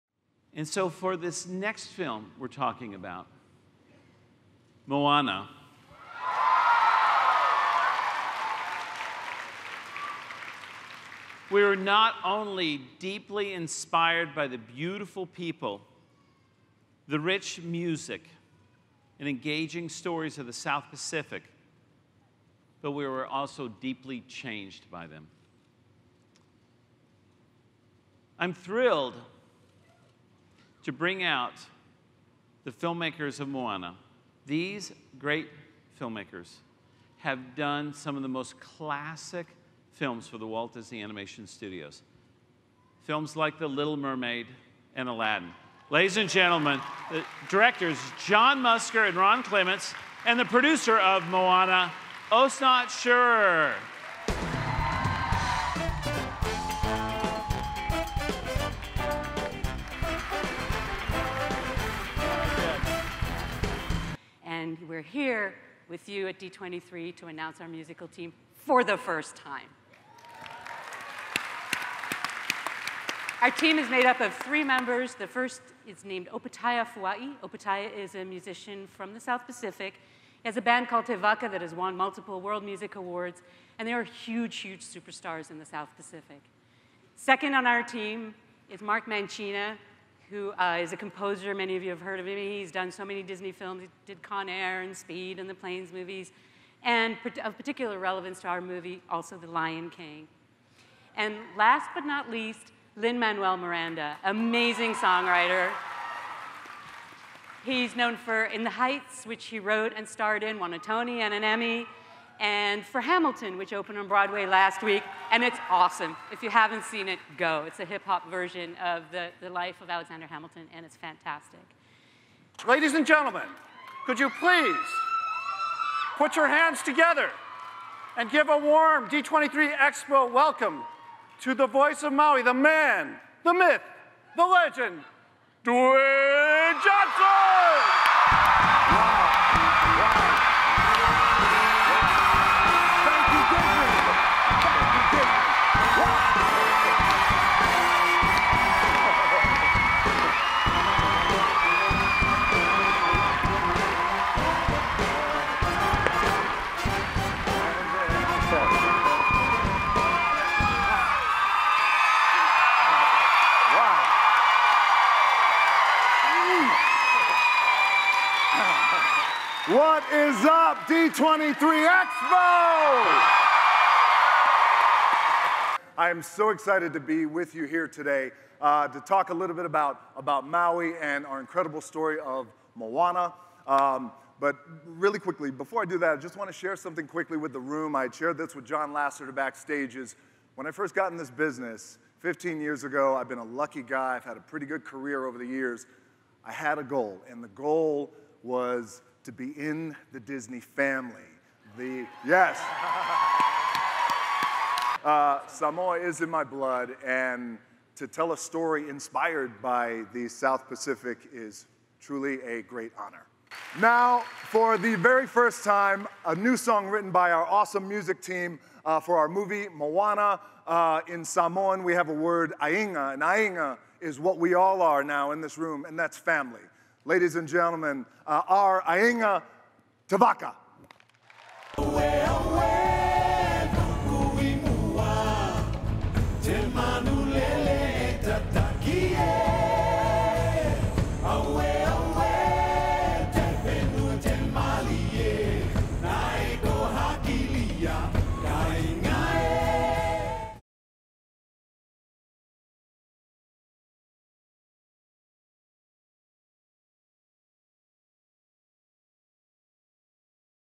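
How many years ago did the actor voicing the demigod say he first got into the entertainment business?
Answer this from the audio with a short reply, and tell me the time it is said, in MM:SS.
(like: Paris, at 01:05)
15, at 03:12.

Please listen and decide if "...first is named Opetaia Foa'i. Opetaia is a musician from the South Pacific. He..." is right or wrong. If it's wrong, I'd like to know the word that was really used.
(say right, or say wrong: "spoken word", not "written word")
right.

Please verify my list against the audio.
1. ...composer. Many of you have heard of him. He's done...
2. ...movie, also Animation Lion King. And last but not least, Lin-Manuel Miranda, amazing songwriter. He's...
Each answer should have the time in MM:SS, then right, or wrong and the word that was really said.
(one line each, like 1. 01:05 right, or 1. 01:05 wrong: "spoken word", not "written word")
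1. 01:30 right
2. 01:38 wrong: "The", not "Animation".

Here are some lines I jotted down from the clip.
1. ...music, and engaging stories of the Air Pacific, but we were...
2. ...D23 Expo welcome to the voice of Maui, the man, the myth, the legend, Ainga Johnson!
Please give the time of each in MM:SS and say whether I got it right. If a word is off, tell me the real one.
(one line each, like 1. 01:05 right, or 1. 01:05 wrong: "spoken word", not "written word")
1. 00:17 wrong: "South", not "Air"
2. 02:09 wrong: "Dwayne", not "Ainga".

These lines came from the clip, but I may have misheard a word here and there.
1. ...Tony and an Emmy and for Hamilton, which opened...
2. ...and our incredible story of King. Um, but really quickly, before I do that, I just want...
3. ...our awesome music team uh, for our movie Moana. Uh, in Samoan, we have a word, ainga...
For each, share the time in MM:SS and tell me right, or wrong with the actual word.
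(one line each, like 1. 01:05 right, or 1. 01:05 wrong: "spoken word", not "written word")
1. 01:50 right
2. 03:00 wrong: "Moana", not "King"
3. 03:37 right.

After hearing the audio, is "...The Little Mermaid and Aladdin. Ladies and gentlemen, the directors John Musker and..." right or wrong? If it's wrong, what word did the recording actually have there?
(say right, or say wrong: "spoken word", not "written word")
right.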